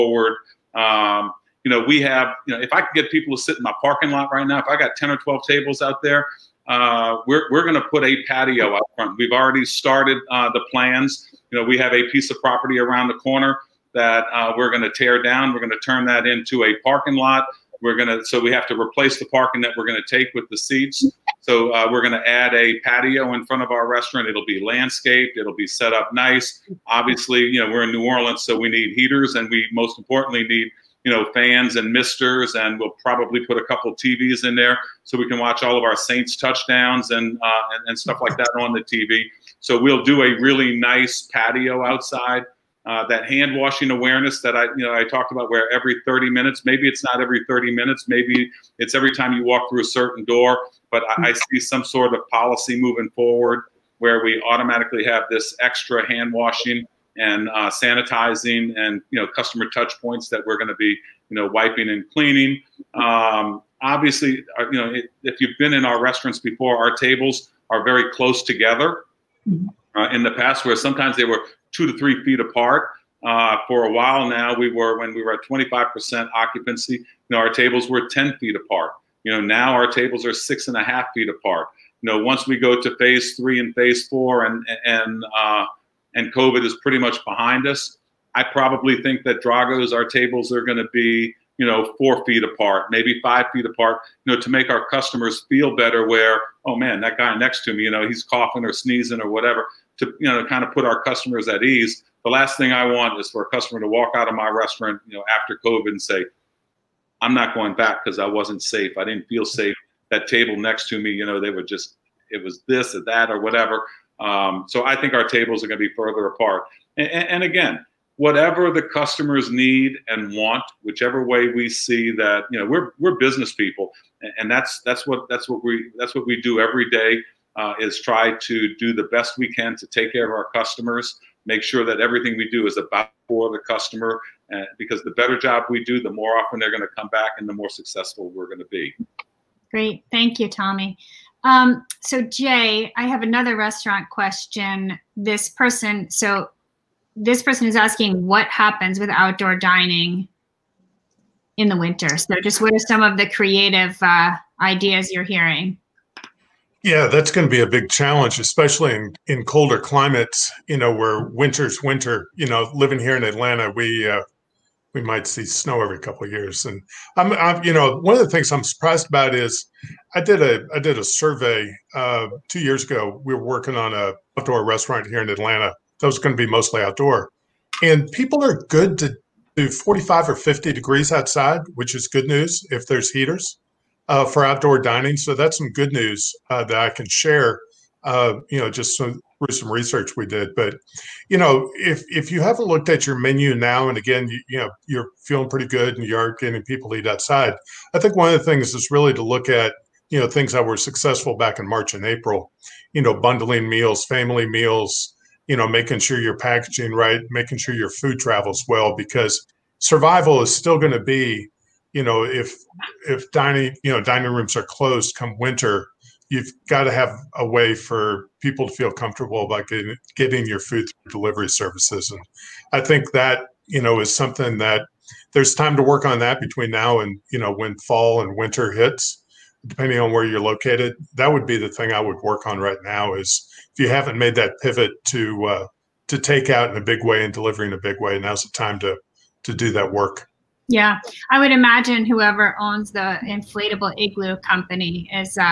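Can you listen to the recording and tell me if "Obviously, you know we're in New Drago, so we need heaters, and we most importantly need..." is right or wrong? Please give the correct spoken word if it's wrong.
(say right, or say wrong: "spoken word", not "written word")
wrong: "Orleans", not "Drago".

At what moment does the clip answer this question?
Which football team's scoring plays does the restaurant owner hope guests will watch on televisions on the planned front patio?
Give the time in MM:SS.
00:35.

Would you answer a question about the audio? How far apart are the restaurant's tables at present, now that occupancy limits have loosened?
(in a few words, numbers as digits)
6.5 feet.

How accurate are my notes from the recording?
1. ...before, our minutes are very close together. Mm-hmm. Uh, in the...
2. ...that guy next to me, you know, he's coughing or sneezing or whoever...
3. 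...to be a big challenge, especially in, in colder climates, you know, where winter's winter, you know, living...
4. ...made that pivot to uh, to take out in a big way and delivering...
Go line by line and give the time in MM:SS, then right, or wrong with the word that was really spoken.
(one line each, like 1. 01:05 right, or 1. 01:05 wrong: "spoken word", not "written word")
1. 01:06 wrong: "tables", not "minutes"
2. 01:37 wrong: "whatever", not "whoever"
3. 02:37 right
4. 03:54 right.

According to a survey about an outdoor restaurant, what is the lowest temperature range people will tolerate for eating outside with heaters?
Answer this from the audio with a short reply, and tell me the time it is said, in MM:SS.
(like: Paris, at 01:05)
45 or 50 degrees, at 02:59.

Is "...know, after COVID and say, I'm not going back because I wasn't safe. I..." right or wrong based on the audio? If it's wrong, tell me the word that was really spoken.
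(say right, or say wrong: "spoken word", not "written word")
right.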